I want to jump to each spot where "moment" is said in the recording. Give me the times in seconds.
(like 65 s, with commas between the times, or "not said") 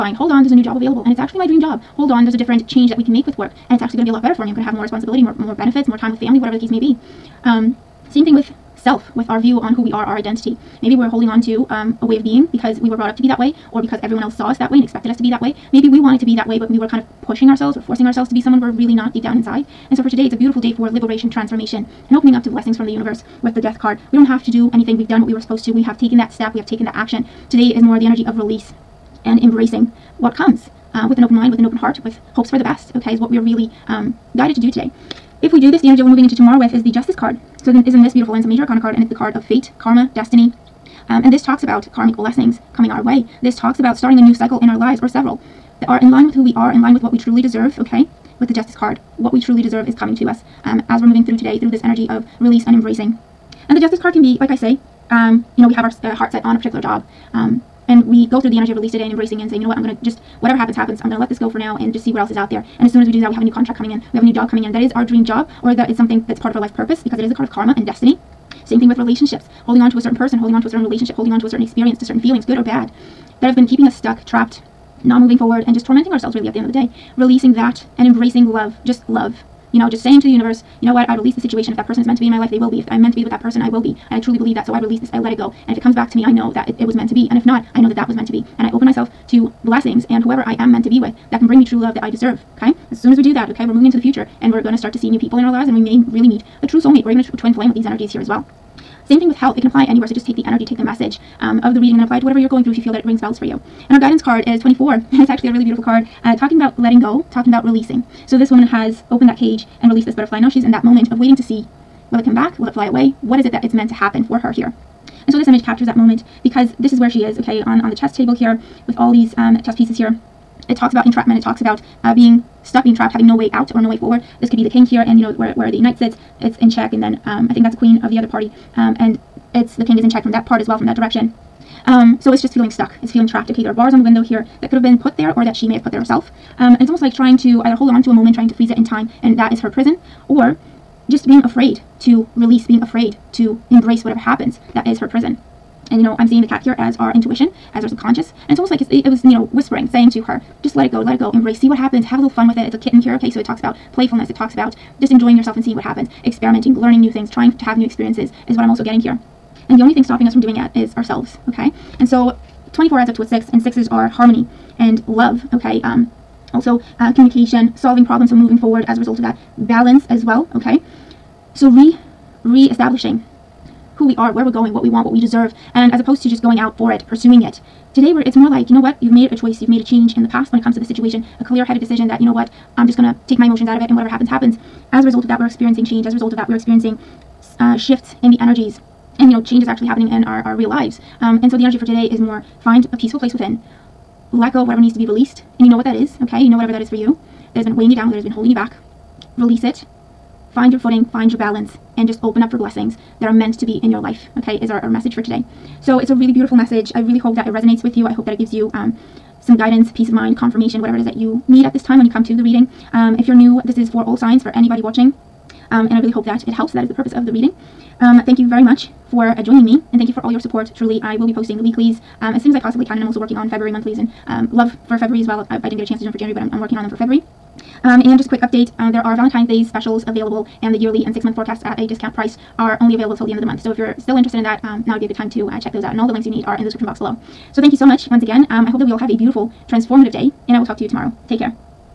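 110 s, 115 s, 138 s.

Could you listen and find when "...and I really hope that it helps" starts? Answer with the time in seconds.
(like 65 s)
215 s.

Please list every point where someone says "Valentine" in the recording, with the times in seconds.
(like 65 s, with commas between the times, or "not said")
229 s.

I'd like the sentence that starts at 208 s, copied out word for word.
Um, some guidance, peace of mind, confirmation, whatever it is that you need at this time when you come to the reading.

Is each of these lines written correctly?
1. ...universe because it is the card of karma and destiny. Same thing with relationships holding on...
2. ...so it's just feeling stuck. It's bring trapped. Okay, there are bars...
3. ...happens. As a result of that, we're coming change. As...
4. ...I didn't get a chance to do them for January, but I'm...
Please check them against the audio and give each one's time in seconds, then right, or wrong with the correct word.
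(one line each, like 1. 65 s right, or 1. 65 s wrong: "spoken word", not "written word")
1. 66 s wrong: "purpose", not "universe"
2. 132 s wrong: "feeling", not "bring"
3. 184 s wrong: "experiencing", not "coming"
4. 225 s right.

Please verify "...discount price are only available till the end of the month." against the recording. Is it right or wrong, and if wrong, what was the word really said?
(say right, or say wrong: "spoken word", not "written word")
right.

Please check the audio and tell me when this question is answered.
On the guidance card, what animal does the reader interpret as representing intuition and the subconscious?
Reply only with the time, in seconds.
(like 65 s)
146 s.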